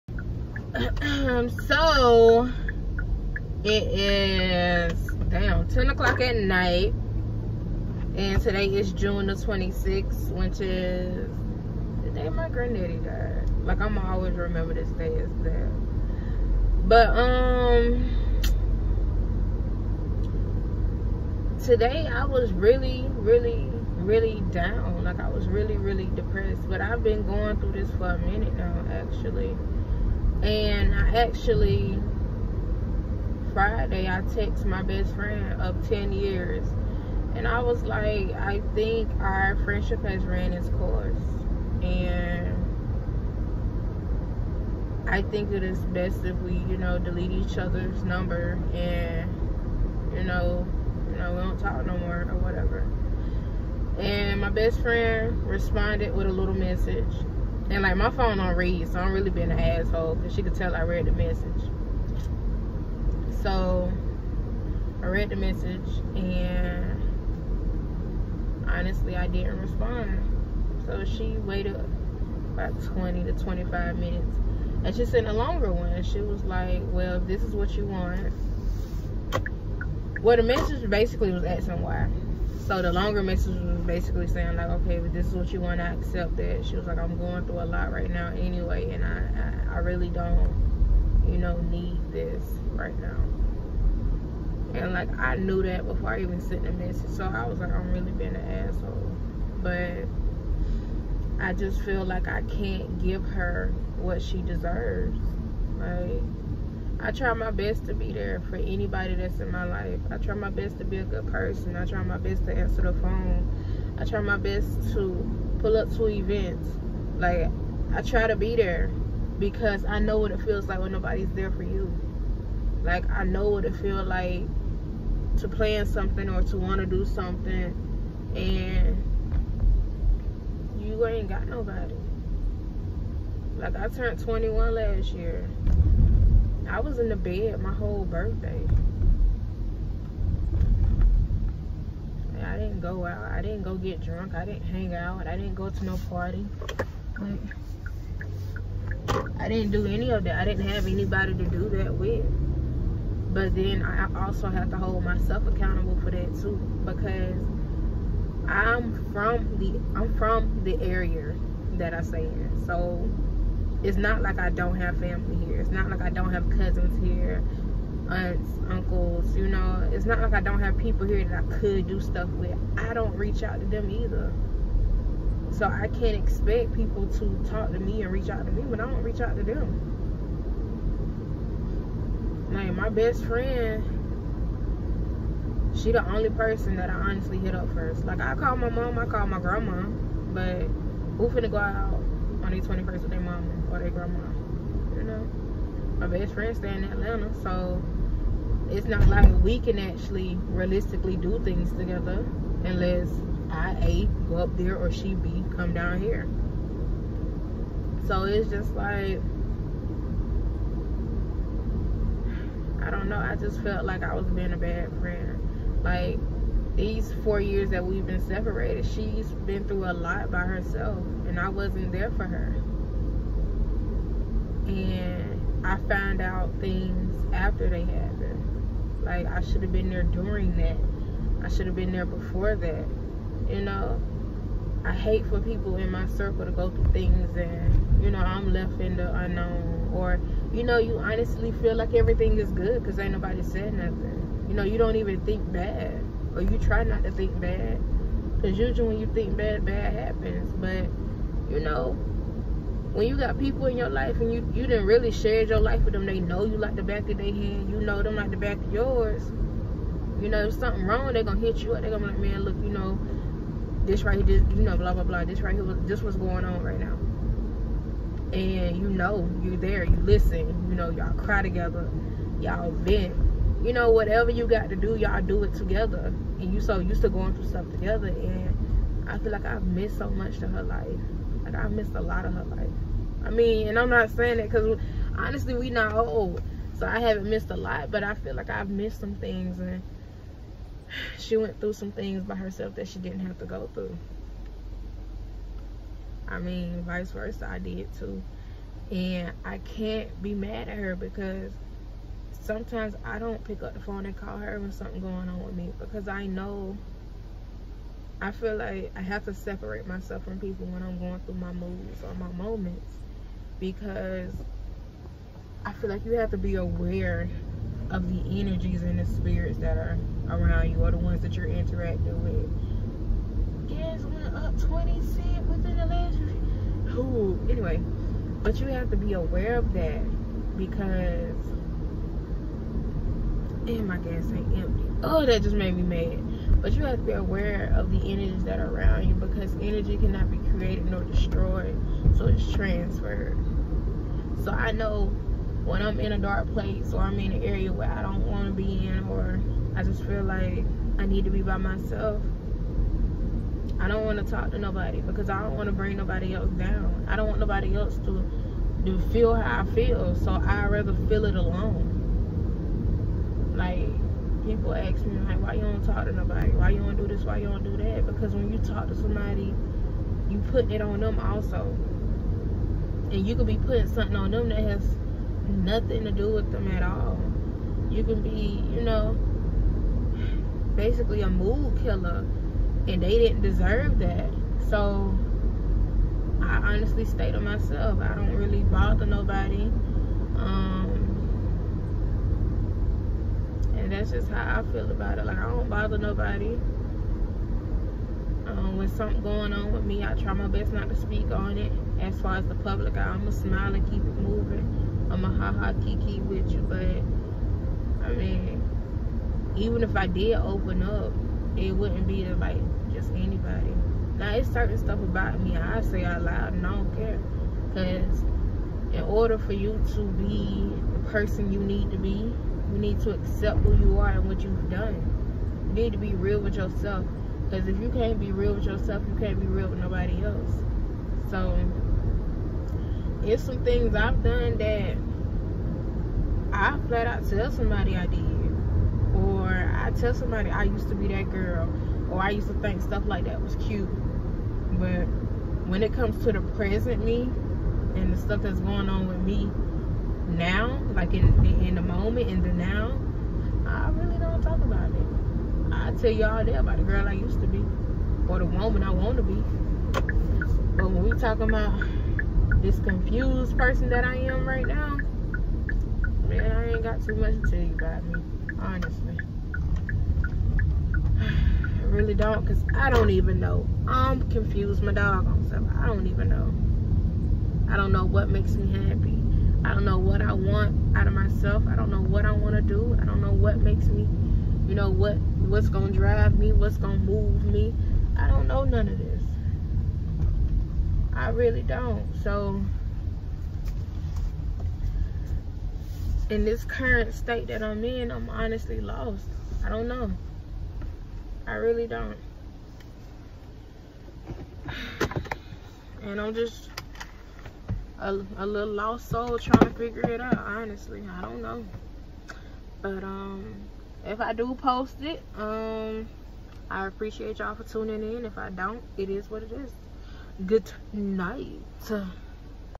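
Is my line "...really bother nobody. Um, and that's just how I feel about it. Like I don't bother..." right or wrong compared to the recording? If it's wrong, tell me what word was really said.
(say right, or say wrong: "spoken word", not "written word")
right.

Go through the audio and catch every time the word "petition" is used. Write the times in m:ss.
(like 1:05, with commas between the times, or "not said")
not said.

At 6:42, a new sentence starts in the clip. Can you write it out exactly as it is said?
As far as the public, I'm going to smile and keep it moving.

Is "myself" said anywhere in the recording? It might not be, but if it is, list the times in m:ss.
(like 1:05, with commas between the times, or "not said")
2:35, 5:09, 5:51, 6:27, 8:01.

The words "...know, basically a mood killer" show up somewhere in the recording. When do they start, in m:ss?
6:18.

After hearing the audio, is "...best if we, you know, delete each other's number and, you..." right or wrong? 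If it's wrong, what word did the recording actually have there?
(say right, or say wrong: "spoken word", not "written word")
right.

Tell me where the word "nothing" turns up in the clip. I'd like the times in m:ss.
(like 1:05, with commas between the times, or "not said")
4:03, 6:15.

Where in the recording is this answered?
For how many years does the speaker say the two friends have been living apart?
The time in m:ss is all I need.
3:37.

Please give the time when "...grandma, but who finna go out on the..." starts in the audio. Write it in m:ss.
3:09.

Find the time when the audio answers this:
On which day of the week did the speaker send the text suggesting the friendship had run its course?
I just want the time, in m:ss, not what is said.
0:33.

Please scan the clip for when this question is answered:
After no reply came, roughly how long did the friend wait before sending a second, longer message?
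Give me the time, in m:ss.
1:12.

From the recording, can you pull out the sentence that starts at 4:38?
And I feel like I've missed so much to her life.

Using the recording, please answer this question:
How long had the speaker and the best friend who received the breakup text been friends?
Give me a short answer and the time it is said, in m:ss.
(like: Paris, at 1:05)
10 years, at 0:35.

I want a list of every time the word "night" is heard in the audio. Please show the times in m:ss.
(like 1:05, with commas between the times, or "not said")
0:06, 8:40.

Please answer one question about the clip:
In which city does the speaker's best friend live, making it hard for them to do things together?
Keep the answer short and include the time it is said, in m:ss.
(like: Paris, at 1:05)
Atlanta, at 3:16.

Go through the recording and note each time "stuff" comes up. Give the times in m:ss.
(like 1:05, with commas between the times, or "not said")
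2:51, 4:37, 6:54, 7:22, 7:28, 7:55.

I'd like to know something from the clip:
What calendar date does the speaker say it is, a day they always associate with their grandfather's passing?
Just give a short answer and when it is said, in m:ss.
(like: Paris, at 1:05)
June 26, at 0:08.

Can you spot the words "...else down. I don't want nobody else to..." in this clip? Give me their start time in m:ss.
5:56.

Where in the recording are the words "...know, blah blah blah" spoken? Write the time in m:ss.
4:24.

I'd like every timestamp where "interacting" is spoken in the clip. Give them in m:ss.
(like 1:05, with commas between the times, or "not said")
5:21.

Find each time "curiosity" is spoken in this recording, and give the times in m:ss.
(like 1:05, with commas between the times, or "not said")
not said.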